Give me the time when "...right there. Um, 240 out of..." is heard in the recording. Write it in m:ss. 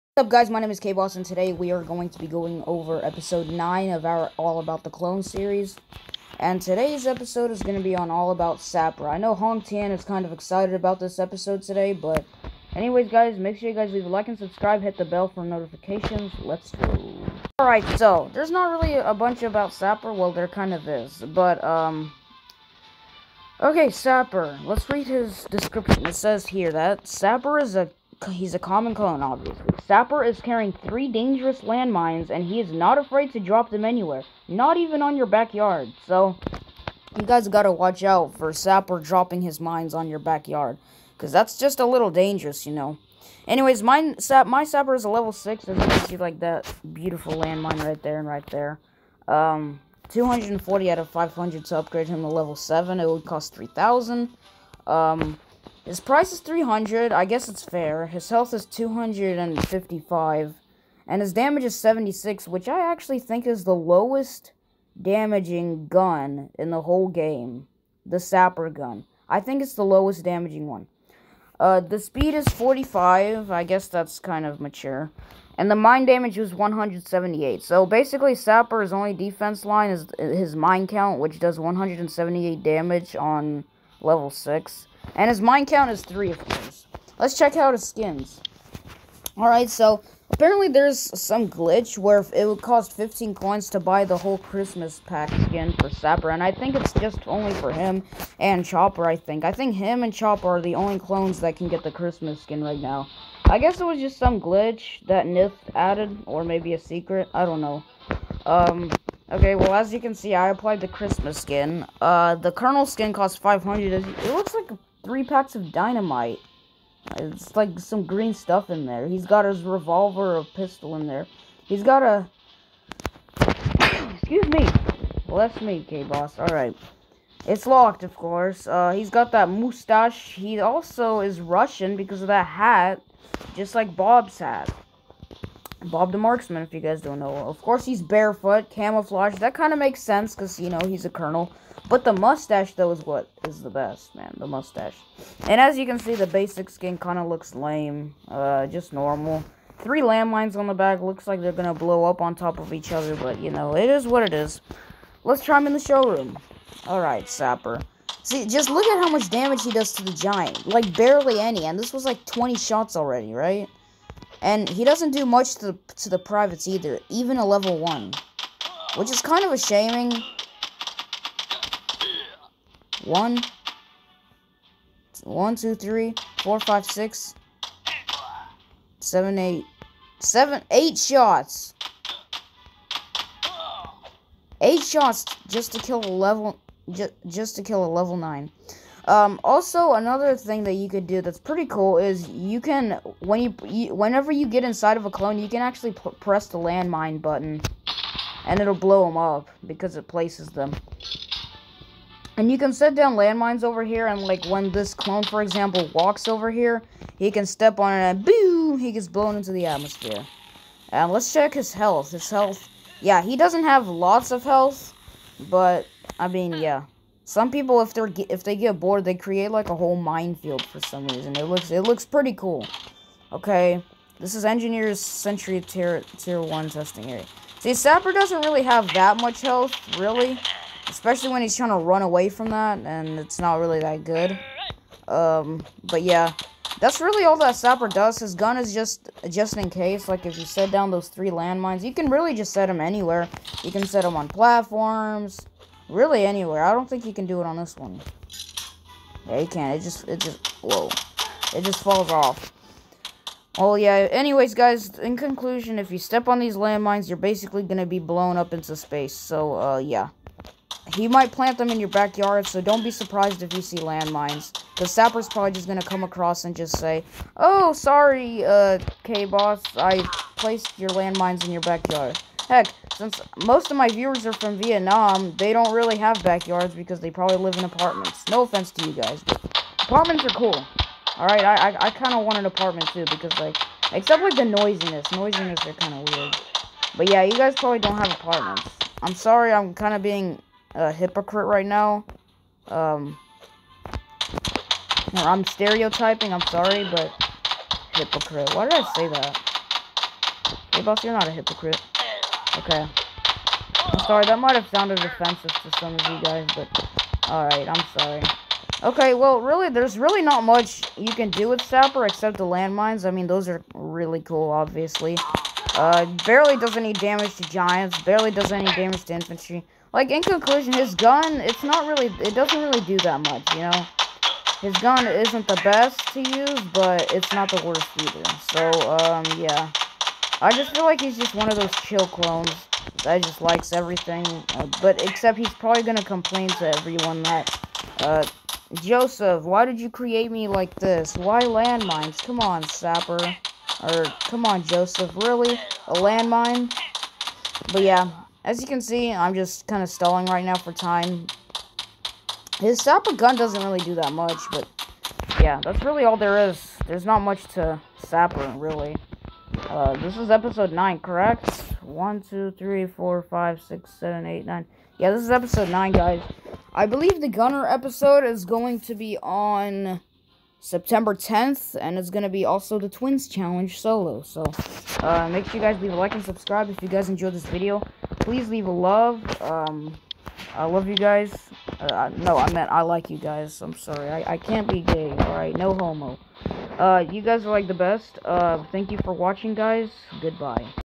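0:48.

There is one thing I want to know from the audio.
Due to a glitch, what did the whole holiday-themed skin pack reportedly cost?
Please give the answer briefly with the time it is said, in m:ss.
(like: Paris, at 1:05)
15, at 1:32.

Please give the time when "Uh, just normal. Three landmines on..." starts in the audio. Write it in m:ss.
2:28.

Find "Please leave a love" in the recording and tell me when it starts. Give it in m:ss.
6:18.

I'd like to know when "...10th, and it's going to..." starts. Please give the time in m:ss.
6:11.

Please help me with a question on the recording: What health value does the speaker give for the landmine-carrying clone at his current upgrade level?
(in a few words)
255.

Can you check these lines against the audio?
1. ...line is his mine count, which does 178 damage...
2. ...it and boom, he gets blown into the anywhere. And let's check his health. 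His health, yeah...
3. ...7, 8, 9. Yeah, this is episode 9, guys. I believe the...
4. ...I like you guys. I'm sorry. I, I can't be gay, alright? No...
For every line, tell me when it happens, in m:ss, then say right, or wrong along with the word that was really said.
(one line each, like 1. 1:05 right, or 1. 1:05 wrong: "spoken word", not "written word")
1. 1:19 right
2. 3:27 wrong: "atmosphere", not "anywhere"
3. 6:03 right
4. 6:22 right.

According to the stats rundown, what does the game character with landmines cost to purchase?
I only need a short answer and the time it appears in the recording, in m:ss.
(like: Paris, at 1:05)
300, at 0:55.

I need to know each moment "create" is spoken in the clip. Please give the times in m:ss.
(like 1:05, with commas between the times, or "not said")
3:39, 5:39.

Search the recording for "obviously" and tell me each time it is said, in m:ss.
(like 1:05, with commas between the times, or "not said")
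0:29, 5:14.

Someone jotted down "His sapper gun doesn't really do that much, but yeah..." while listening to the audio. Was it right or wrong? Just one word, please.
right.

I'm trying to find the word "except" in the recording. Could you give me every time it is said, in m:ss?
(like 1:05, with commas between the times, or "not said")
4:43, 5:12, 5:35.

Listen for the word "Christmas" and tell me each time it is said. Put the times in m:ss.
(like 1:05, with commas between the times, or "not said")
1:34, 1:41, 1:50.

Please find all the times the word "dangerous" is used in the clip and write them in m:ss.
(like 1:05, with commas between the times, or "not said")
0:31, 0:42.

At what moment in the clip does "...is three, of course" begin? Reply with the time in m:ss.
1:25.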